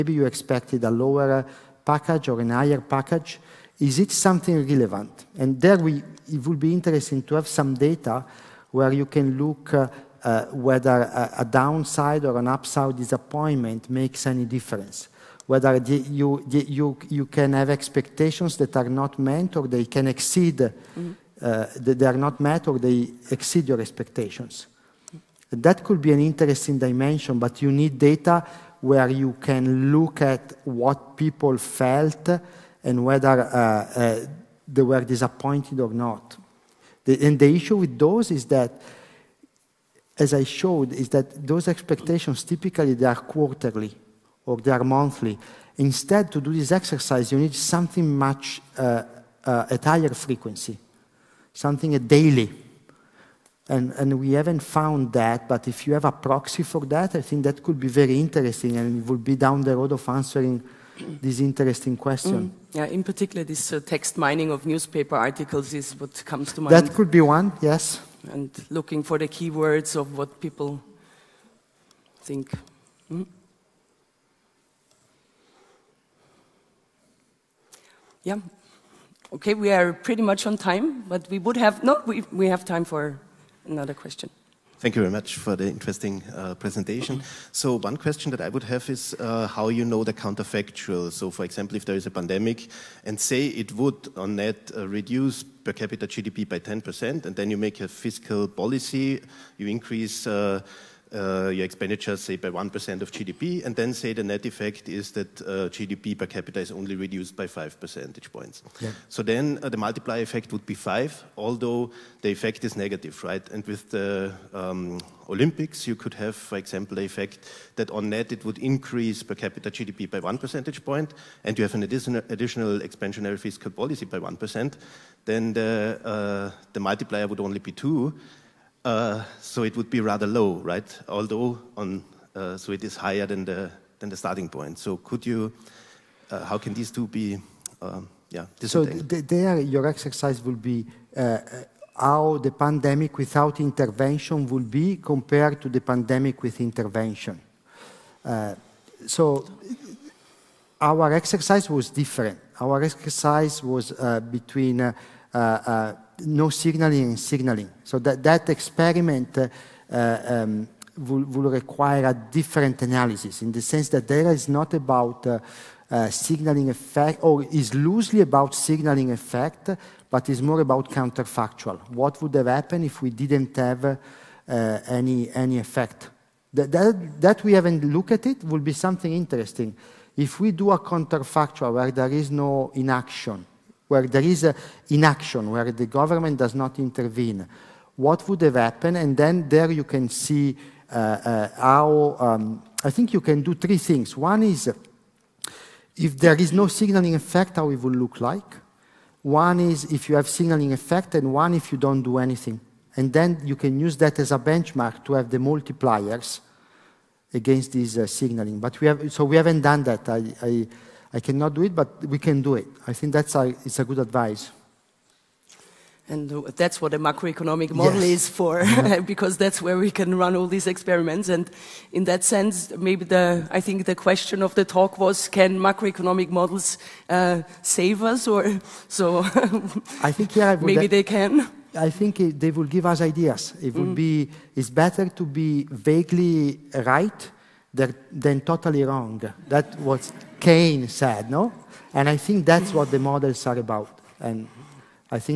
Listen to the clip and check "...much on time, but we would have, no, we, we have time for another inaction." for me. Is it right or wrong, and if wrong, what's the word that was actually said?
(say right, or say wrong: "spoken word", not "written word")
wrong: "question", not "inaction".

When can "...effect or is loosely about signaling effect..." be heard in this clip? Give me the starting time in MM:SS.
02:46.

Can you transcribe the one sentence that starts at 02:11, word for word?
Although on, uh, so it is higher than the than the starting point.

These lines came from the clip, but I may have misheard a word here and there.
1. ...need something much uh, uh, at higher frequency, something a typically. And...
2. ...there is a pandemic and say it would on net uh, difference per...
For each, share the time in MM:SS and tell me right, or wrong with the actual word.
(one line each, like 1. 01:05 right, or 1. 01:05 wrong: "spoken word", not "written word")
1. 00:47 wrong: "daily", not "typically"
2. 01:31 wrong: "reduce", not "difference".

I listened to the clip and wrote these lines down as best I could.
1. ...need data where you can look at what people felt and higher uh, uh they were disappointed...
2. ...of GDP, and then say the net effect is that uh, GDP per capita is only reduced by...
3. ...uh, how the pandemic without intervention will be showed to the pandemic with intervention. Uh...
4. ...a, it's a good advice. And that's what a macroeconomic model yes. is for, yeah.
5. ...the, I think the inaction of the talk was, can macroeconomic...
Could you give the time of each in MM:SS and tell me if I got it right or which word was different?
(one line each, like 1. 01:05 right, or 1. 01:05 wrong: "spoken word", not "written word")
1. 00:27 wrong: "whether", not "higher"
2. 01:43 right
3. 02:21 wrong: "compared", not "showed"
4. 03:33 right
5. 03:43 wrong: "question", not "inaction".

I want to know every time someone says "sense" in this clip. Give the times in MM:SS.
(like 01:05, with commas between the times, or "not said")
02:43, 03:42.